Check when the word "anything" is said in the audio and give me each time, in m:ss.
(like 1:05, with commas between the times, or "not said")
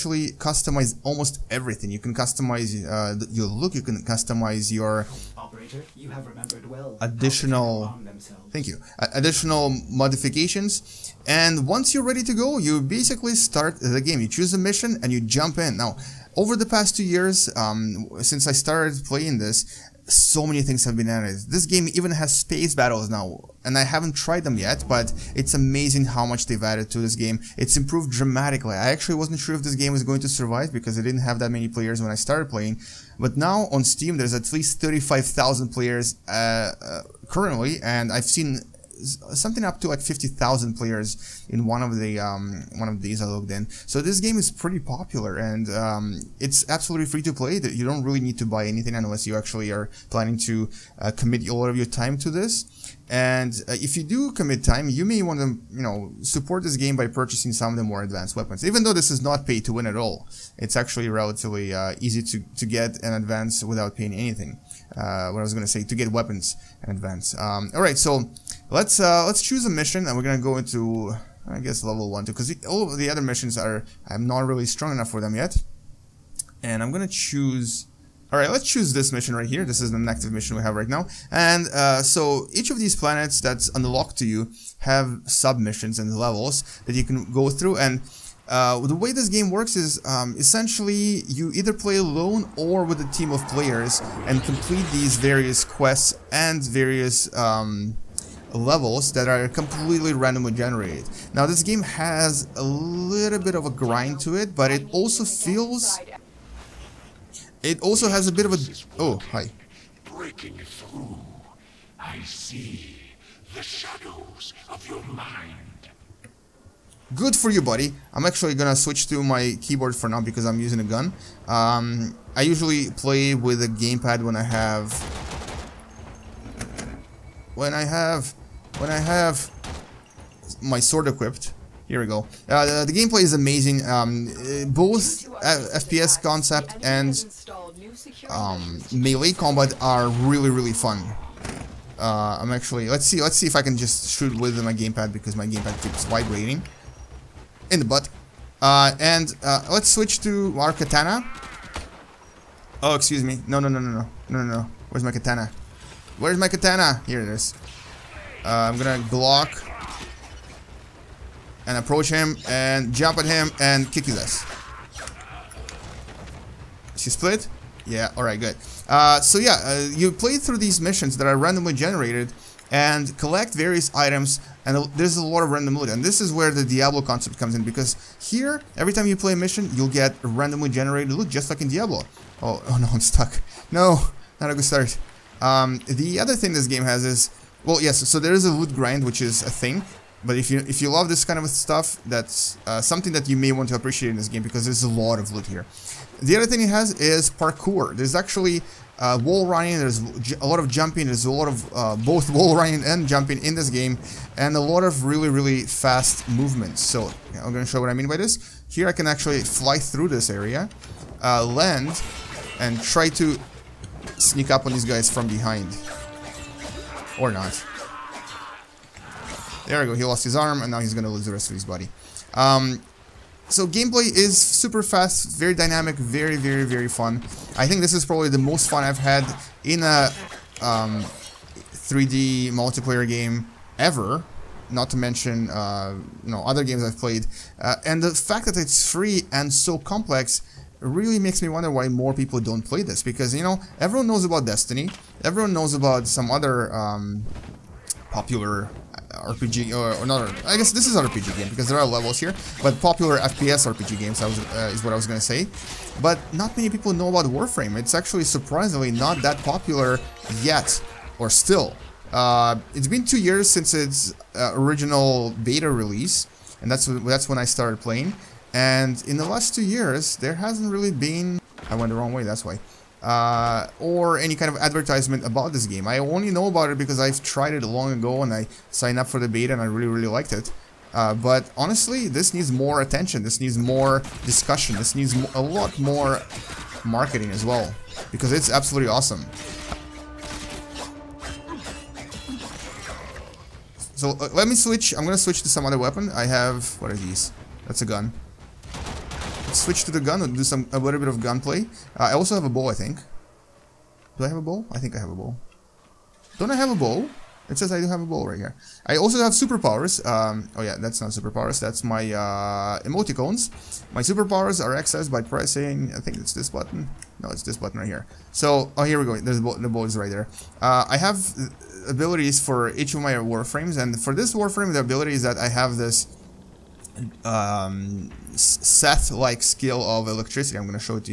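0:48, 1:04.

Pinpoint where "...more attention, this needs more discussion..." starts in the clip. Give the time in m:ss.
4:42.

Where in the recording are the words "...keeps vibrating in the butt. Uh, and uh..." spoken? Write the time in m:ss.
2:25.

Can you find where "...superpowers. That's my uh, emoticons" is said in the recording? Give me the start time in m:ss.
5:11.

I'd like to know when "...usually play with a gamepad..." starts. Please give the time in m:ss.
2:02.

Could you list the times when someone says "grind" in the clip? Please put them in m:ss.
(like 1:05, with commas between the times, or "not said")
1:43, 3:08.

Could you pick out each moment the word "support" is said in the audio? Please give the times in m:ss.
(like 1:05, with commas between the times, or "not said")
0:56.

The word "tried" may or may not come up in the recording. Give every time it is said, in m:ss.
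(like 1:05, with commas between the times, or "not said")
0:24, 4:37.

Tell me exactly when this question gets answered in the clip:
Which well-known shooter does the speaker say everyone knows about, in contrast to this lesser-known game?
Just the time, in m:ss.
4:04.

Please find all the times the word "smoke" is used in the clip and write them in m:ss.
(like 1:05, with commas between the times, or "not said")
not said.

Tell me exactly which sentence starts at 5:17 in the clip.
No, it's this button right here.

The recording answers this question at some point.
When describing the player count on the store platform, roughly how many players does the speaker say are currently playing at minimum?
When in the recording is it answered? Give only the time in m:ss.
0:34.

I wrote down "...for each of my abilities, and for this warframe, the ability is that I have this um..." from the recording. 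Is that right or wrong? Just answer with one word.
wrong.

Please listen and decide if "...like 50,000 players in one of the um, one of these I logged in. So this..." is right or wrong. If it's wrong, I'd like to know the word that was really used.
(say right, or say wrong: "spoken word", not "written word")
right.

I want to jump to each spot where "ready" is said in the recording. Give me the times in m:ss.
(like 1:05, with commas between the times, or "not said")
0:12.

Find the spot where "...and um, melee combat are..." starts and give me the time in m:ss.
2:16.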